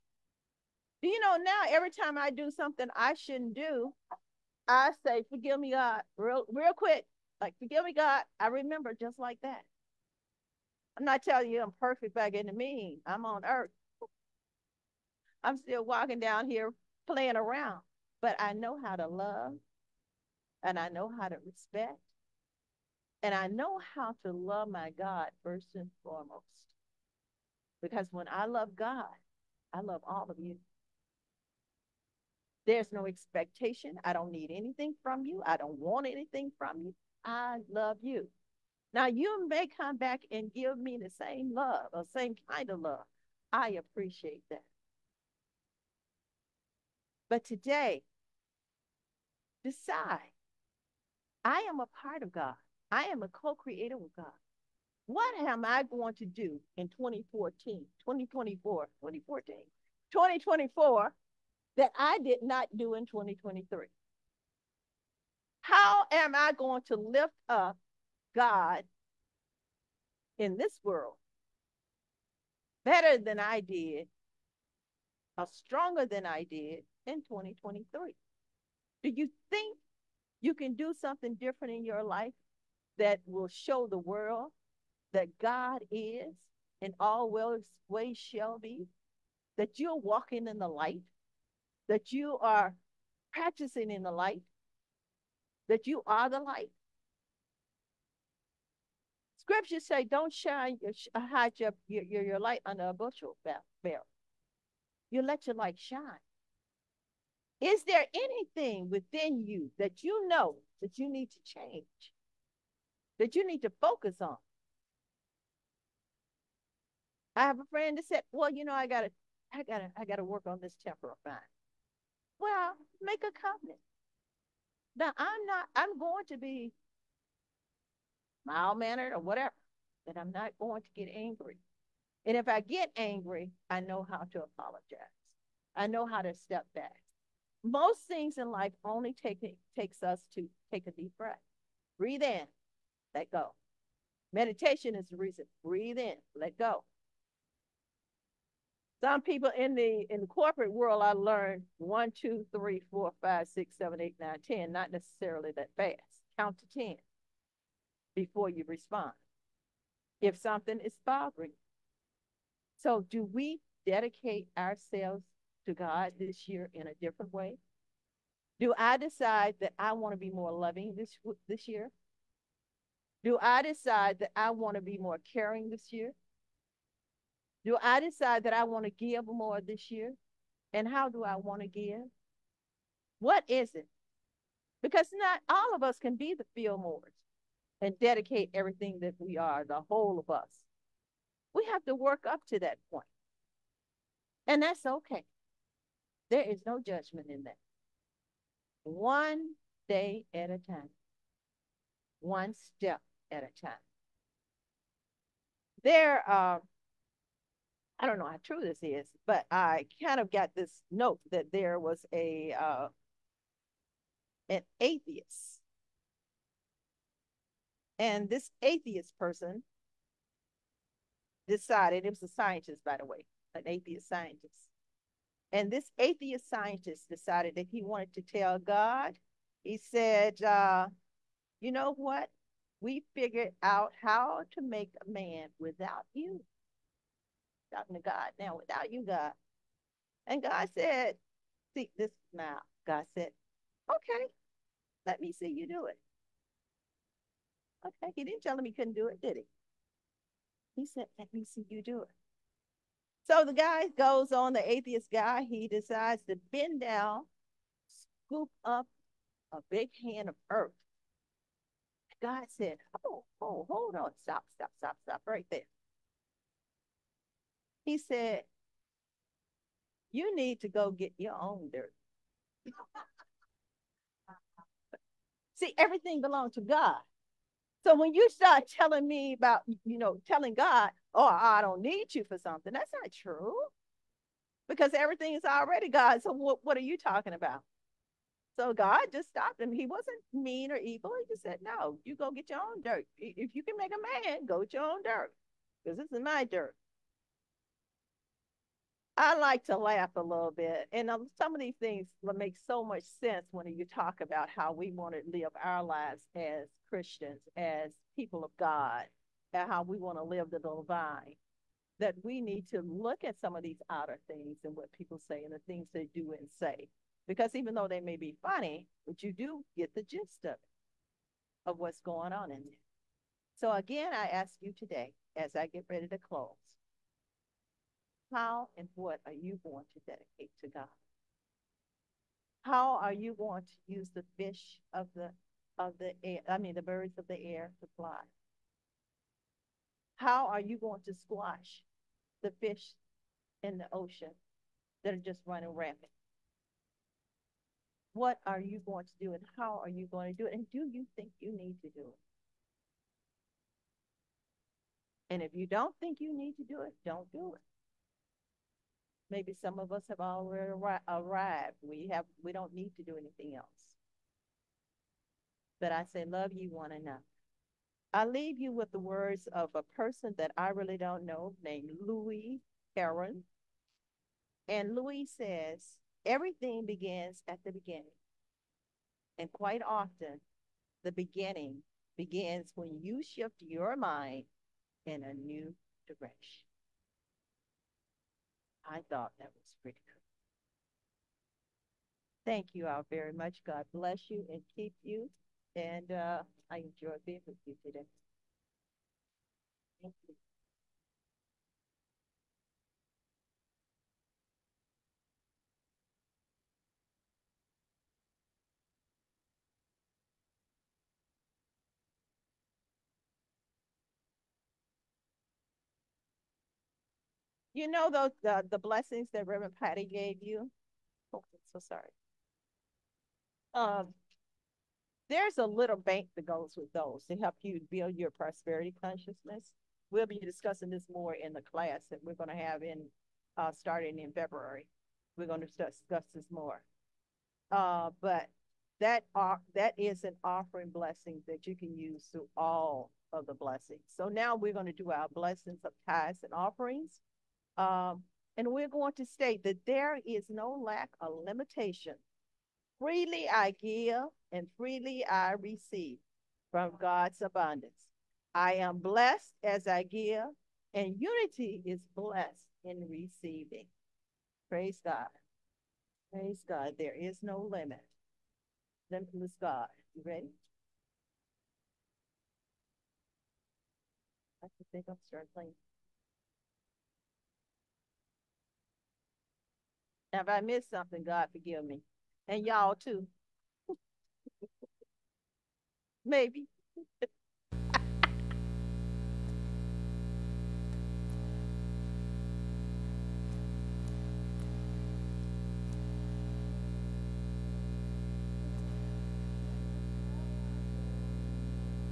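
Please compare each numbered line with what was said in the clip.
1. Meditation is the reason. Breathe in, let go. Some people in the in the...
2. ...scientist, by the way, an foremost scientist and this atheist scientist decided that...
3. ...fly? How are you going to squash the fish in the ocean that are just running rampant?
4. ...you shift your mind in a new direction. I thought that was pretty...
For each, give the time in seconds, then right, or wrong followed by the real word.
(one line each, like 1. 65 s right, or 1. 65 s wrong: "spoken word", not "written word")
1. 144 s right
2. 222 s wrong: "atheist", not "foremost"
3. 337 s right
4. 383 s right.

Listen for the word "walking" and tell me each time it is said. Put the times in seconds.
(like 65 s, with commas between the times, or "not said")
15 s, 89 s.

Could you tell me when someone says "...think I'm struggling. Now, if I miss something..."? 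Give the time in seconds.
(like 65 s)
474 s.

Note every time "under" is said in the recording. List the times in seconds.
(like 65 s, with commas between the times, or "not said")
102 s.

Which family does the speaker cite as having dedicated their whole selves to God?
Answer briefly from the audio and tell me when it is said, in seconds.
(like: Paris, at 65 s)
The Fillmores, at 186 s.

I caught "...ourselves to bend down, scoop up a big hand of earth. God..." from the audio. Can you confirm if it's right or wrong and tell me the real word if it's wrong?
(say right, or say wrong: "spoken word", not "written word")
wrong: "decides", not "ourselves".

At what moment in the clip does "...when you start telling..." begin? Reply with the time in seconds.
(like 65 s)
277 s.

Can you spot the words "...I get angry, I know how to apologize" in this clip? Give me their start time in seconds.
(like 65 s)
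132 s.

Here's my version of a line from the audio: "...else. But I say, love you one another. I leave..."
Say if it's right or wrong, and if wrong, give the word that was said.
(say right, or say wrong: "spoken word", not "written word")
right.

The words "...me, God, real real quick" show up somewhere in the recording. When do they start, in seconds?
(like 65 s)
5 s.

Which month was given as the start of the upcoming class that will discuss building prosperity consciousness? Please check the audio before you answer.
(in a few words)
February.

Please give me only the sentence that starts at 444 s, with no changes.
So now we're going to do our blessings of tithes and offerings.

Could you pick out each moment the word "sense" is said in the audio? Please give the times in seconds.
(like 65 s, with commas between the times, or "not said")
303 s.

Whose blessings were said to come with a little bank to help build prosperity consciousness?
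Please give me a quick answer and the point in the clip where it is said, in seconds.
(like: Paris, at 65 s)
Reverend Patty, at 419 s.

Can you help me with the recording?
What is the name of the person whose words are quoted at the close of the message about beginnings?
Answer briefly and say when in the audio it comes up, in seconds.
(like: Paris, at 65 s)
Louis Heron, at 372 s.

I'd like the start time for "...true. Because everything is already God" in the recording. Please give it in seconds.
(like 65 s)
283 s.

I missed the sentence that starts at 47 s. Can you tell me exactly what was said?
But today, decide I am a part of God, I am a co creator with God.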